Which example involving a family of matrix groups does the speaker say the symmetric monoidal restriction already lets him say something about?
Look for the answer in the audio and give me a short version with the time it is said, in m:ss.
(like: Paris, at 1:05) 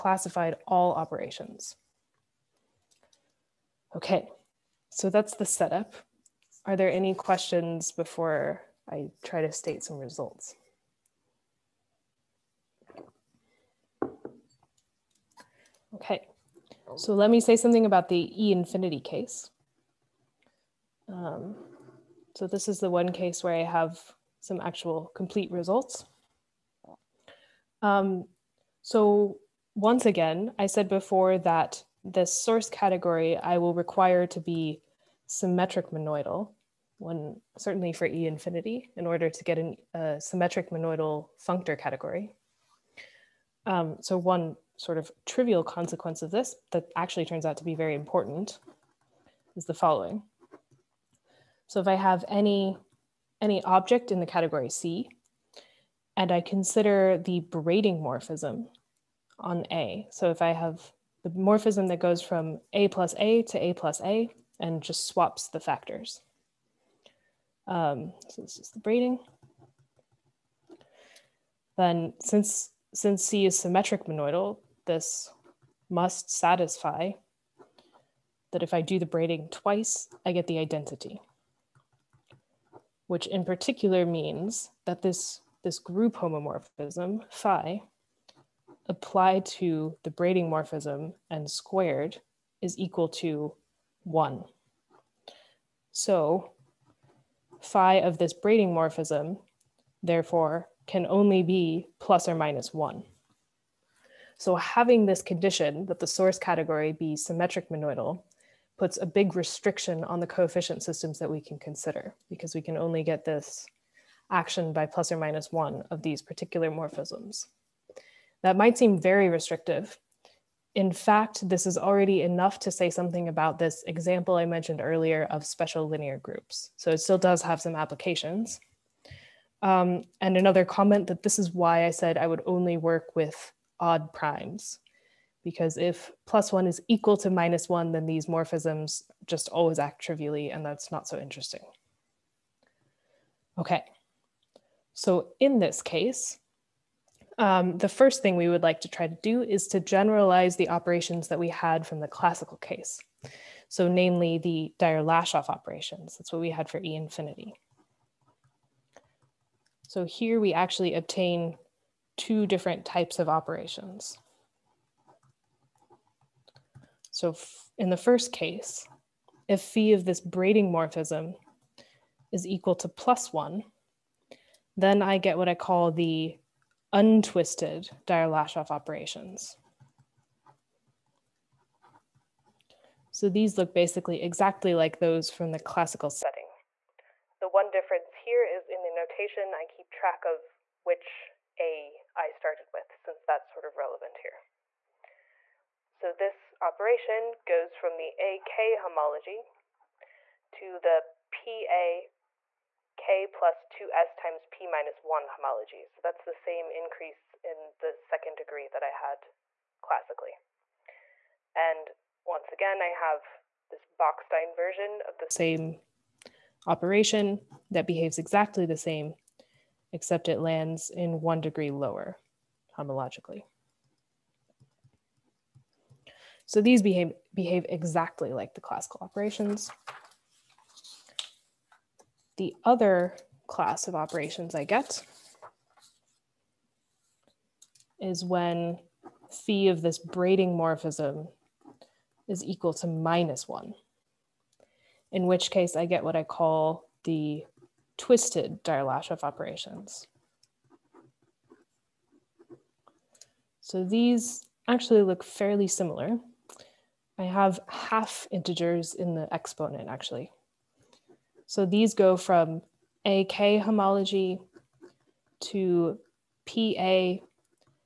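special linear groups, at 2:05.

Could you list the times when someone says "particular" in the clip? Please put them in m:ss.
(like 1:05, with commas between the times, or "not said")
1:23, 1:56.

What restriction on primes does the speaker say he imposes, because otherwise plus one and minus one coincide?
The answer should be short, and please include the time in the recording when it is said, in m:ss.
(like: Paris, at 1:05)
odd primes, at 2:13.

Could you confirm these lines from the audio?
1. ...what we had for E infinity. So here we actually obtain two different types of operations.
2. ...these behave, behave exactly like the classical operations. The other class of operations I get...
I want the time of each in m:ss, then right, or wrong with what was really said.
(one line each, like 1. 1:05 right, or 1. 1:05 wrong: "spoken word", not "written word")
1. 2:36 right
2. 3:46 right.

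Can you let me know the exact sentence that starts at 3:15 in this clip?
So this operation goes from the AK homology to the PA K plus 2S times P minus 1 homology.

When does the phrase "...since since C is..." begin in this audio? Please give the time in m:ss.
1:12.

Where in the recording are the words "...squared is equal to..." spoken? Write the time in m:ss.
1:31.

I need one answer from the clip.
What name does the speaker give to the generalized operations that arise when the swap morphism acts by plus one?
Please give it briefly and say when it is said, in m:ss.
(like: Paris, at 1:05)
untwisted Dyer-Lashof operations, at 2:56.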